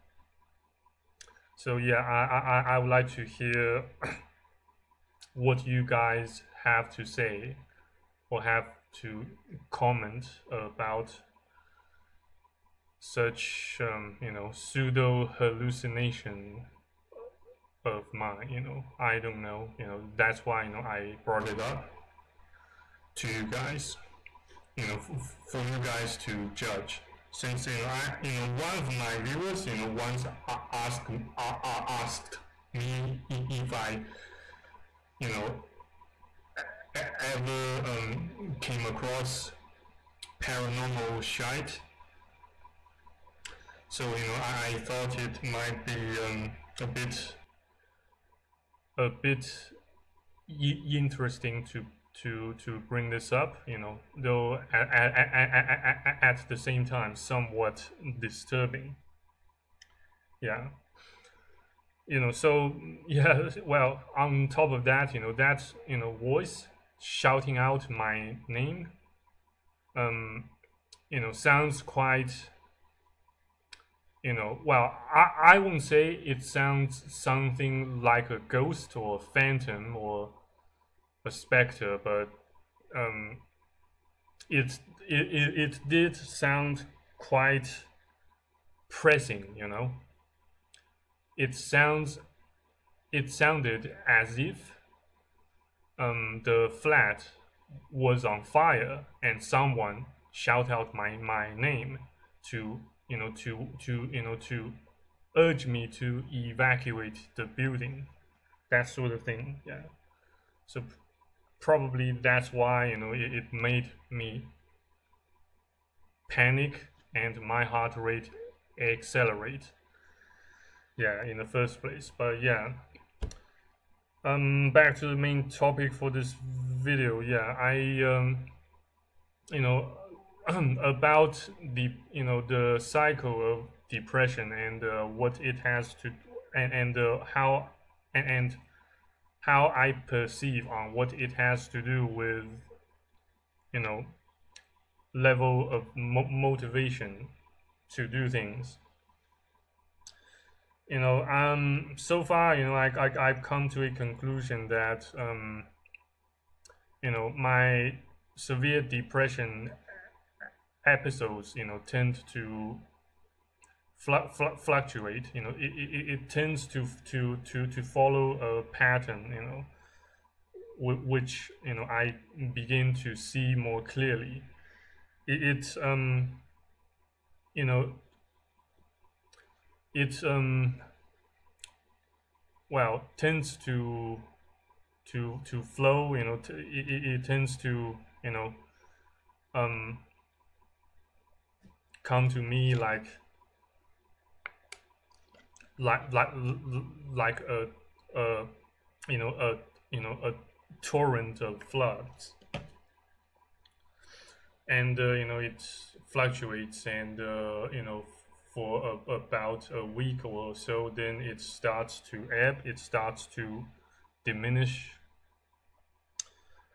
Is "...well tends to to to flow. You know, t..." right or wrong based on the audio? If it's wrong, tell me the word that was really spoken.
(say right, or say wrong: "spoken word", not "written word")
right.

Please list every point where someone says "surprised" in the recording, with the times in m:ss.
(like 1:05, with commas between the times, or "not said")
not said.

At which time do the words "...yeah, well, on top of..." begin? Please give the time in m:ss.
1:03.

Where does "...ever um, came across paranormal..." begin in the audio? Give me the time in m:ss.
0:37.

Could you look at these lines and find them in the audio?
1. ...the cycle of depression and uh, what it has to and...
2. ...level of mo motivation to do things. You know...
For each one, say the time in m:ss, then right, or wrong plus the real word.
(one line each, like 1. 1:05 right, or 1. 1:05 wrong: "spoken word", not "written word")
1. 2:12 right
2. 2:25 right.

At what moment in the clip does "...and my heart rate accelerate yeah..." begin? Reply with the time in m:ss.
1:57.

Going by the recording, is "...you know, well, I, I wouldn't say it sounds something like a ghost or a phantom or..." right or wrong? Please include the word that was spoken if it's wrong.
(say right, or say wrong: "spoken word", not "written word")
right.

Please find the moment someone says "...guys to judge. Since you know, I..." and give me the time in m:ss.
0:25.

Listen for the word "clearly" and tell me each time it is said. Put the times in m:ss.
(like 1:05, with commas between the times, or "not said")
2:53.